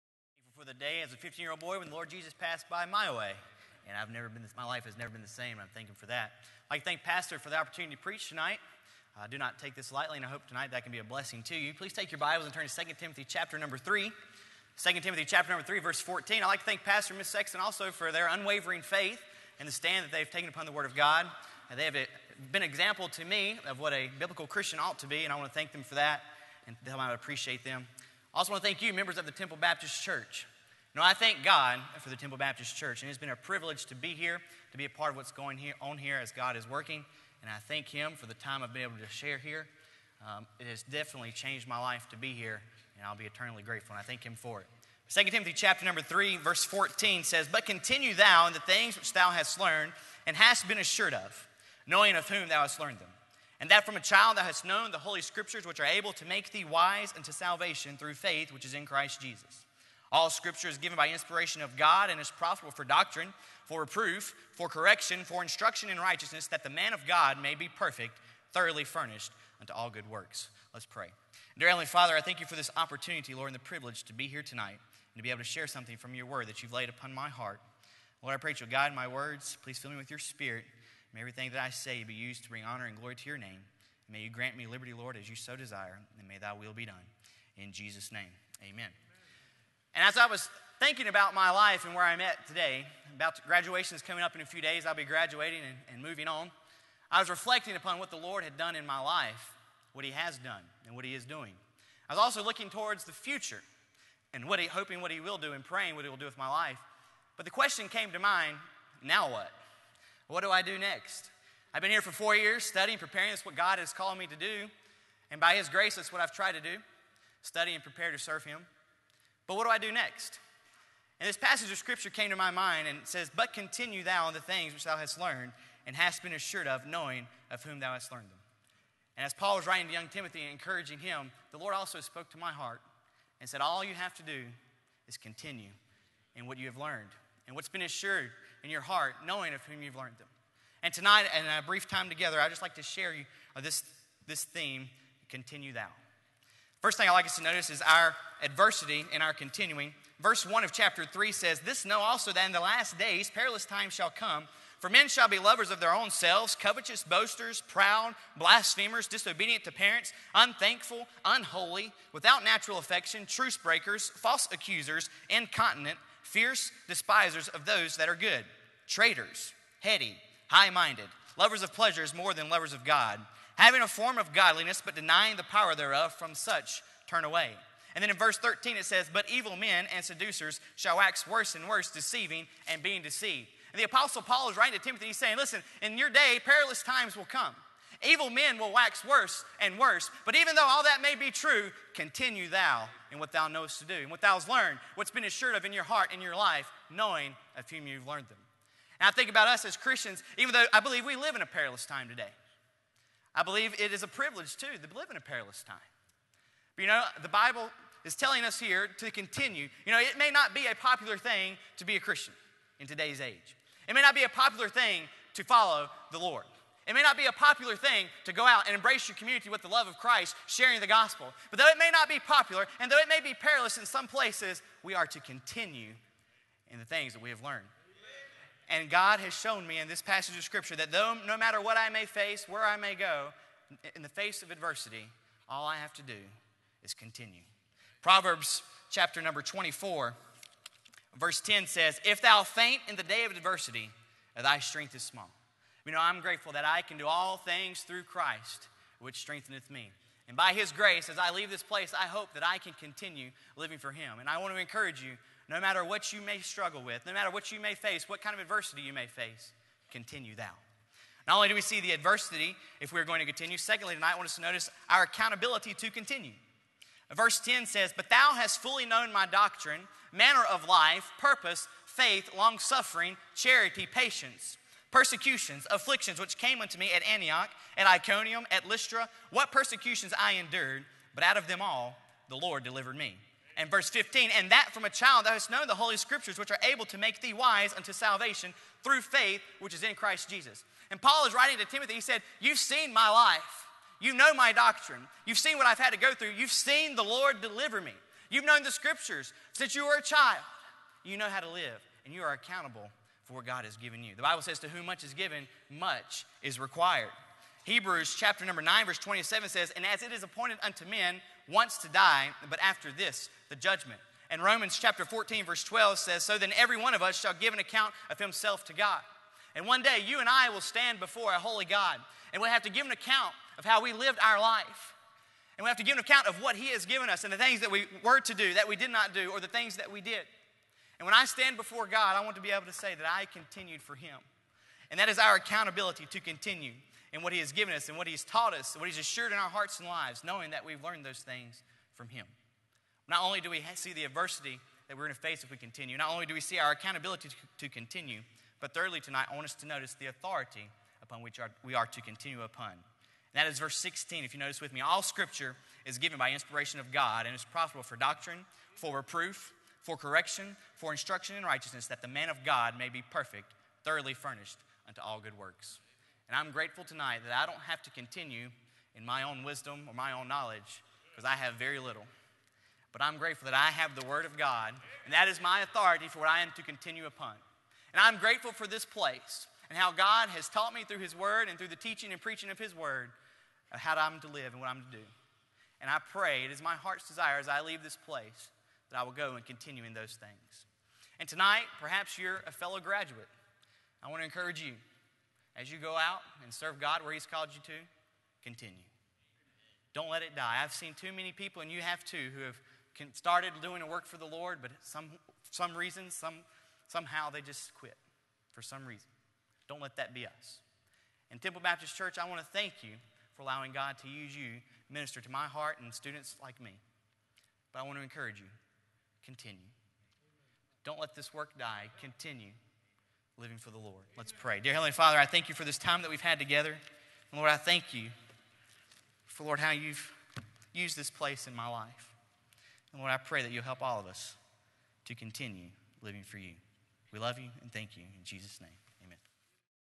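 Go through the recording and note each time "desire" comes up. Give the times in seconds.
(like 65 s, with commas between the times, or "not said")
85 s, 387 s.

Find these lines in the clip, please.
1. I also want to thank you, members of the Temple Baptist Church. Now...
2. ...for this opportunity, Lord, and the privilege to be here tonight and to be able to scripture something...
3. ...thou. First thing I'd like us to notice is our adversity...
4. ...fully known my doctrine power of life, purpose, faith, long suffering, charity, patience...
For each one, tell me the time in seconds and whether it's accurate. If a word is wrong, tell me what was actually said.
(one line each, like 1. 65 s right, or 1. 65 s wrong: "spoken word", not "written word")
1. 28 s right
2. 72 s wrong: "share", not "scripture"
3. 145 s right
4. 268 s wrong: "manner", not "power".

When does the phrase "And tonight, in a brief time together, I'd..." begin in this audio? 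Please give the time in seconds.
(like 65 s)
140 s.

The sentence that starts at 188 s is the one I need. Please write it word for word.
Evil men will wax worse and worse.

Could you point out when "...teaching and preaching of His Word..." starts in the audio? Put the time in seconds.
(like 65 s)
381 s.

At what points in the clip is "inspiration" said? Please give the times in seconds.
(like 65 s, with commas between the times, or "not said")
61 s, 356 s.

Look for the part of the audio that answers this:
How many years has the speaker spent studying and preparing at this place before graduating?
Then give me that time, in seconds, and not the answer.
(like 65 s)
112 s.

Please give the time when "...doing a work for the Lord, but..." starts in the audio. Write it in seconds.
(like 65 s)
403 s.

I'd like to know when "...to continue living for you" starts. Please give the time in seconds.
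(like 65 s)
435 s.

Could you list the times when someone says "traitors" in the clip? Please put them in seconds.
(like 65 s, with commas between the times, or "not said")
168 s.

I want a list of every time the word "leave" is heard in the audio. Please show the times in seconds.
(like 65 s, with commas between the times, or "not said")
251 s, 387 s.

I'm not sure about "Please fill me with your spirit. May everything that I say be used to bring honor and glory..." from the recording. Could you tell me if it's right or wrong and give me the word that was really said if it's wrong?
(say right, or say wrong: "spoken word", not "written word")
right.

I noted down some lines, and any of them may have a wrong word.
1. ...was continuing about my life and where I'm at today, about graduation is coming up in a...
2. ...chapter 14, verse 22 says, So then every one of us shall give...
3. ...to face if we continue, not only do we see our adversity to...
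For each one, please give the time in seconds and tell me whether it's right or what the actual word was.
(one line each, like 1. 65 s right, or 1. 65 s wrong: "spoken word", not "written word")
1. 90 s wrong: "thinking", not "continuing"
2. 314 s wrong: "12", not "22"
3. 345 s wrong: "accountability", not "adversity".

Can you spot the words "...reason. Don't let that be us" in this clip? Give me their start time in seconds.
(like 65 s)
408 s.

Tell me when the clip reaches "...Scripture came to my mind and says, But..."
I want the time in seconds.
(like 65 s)
121 s.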